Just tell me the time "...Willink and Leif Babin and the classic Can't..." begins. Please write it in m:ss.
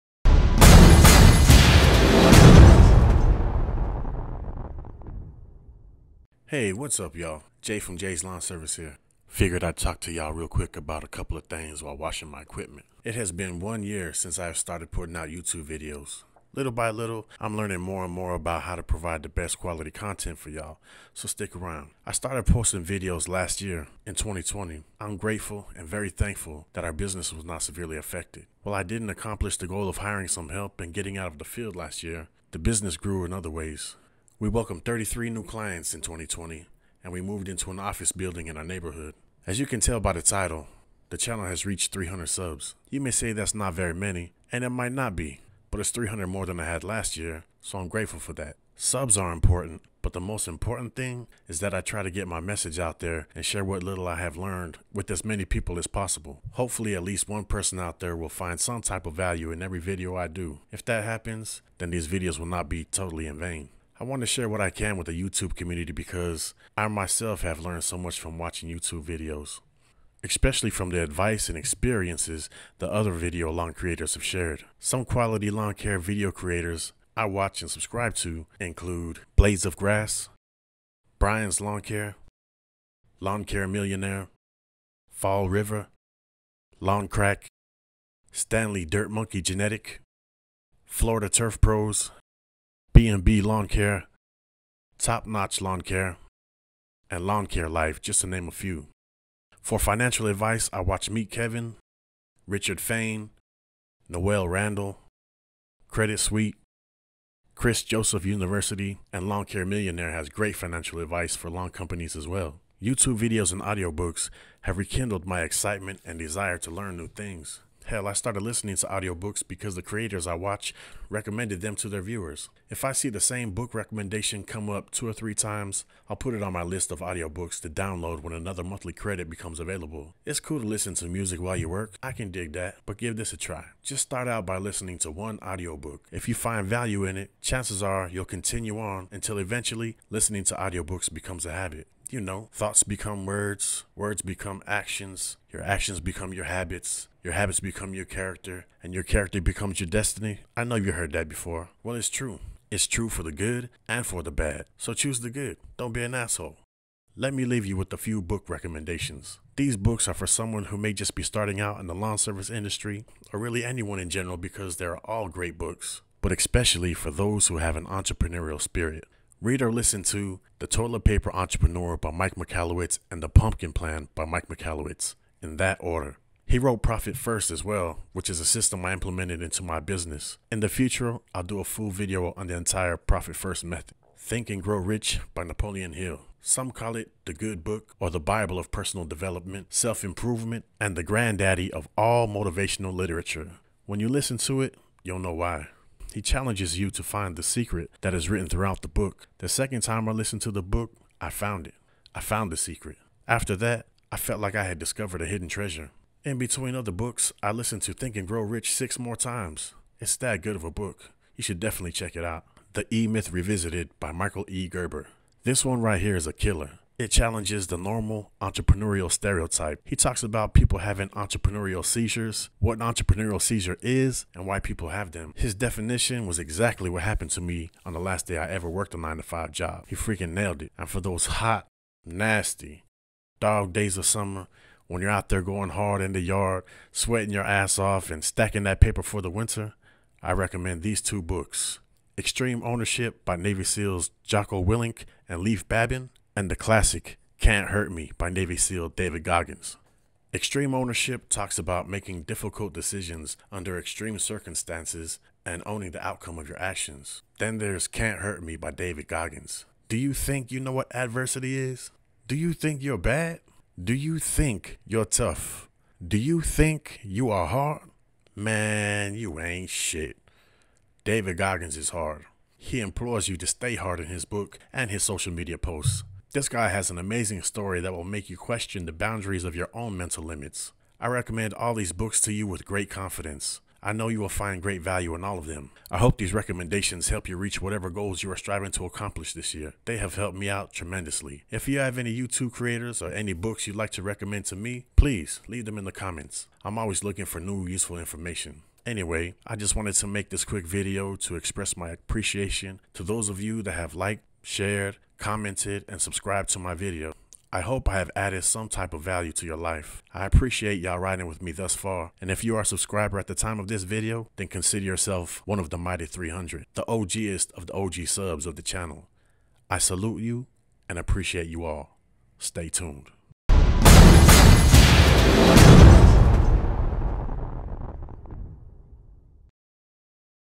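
4:04.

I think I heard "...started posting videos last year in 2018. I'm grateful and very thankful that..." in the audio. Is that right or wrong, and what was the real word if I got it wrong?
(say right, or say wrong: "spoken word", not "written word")
wrong: "2020", not "2018".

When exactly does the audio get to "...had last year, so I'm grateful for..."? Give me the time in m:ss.
0:46.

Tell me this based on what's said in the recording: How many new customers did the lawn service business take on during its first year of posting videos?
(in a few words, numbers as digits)
33.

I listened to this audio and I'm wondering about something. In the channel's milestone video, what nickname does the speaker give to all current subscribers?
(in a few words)
the mighty 300.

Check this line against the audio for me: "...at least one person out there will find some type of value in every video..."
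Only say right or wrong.
right.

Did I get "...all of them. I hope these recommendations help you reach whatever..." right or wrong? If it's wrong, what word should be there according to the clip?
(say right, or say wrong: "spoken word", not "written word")
right.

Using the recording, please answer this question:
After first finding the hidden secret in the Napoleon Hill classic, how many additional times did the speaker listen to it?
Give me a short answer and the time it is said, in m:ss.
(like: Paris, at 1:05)
6, at 3:28.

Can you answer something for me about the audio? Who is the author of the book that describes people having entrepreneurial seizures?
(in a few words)
Michael E. Gerber.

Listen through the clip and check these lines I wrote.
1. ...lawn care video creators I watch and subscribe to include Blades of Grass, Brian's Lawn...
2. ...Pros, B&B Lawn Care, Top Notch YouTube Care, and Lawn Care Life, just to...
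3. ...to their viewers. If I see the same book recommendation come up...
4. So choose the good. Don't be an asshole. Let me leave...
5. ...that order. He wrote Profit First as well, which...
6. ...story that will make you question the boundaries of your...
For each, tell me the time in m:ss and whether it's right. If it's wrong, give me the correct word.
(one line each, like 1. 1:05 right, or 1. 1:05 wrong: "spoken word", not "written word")
1. 1:15 right
2. 1:31 wrong: "Lawn", not "YouTube"
3. 2:01 right
4. 2:34 right
5. 2:55 right
6. 4:37 right.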